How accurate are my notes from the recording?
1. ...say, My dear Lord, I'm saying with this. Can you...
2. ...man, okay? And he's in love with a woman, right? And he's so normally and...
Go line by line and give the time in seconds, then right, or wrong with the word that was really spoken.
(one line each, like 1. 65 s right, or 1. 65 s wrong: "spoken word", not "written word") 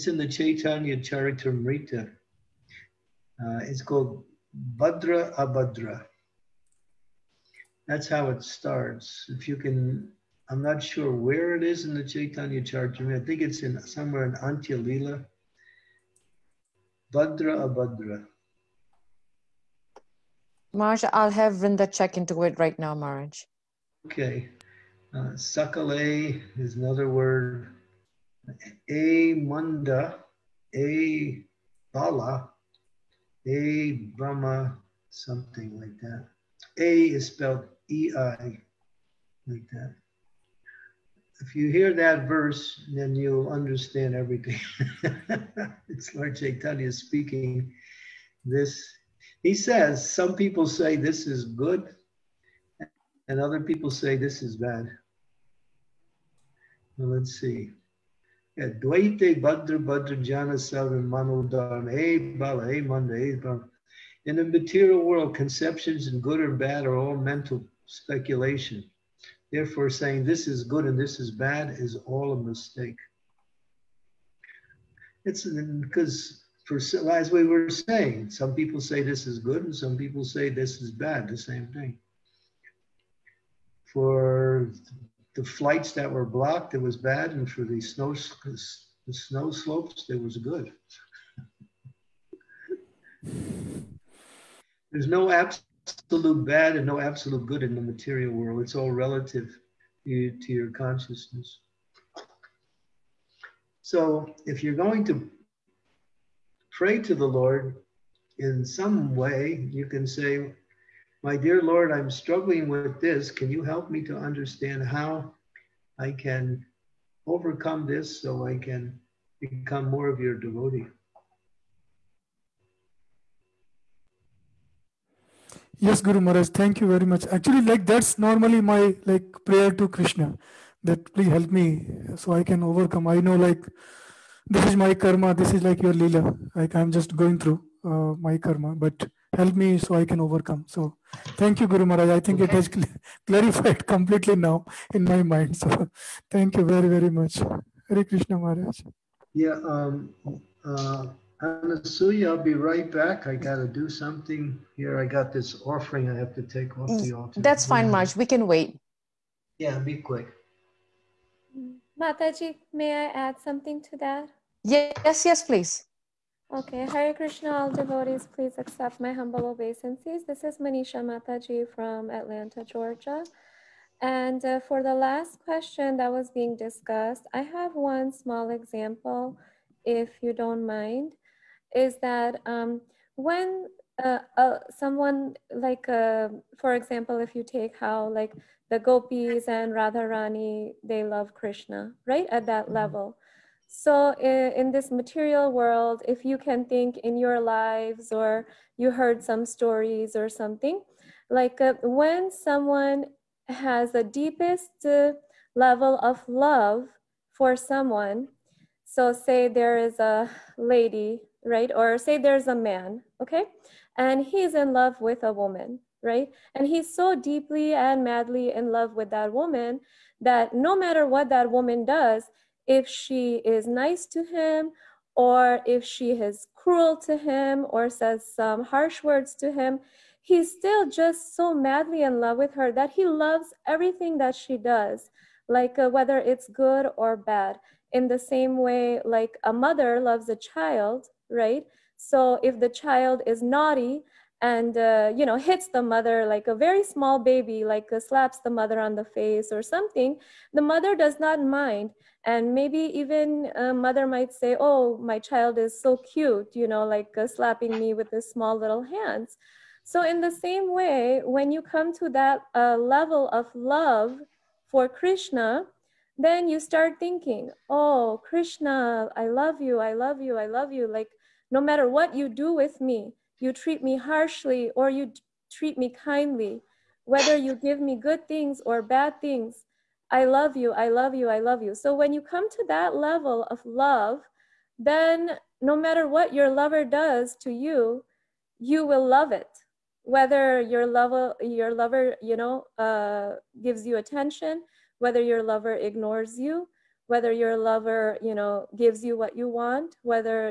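1. 110 s wrong: "struggling", not "saying"
2. 212 s wrong: "deeply", not "normally".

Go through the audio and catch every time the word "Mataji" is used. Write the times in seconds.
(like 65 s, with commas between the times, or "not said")
161 s, 171 s.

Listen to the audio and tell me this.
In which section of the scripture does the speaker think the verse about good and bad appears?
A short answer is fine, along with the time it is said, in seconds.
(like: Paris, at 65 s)
Antya, at 14 s.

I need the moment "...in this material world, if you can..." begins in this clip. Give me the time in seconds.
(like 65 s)
194 s.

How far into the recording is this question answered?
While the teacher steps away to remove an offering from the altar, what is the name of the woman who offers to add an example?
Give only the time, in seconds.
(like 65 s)
170 s.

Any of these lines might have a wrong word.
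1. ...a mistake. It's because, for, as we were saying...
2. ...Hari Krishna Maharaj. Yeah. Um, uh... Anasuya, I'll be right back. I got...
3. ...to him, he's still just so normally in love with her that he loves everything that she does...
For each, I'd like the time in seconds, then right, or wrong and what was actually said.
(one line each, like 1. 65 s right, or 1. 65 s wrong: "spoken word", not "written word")
1. 72 s right
2. 147 s right
3. 229 s wrong: "madly", not "normally".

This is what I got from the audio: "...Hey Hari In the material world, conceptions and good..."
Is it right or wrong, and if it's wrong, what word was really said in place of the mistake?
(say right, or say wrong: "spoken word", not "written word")
wrong: "Manda", not "Hari".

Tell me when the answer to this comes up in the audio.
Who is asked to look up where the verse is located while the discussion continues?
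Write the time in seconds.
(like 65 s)
21 s.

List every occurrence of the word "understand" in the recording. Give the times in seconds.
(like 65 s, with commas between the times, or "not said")
43 s, 114 s.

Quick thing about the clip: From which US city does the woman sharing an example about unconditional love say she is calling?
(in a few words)
Atlanta.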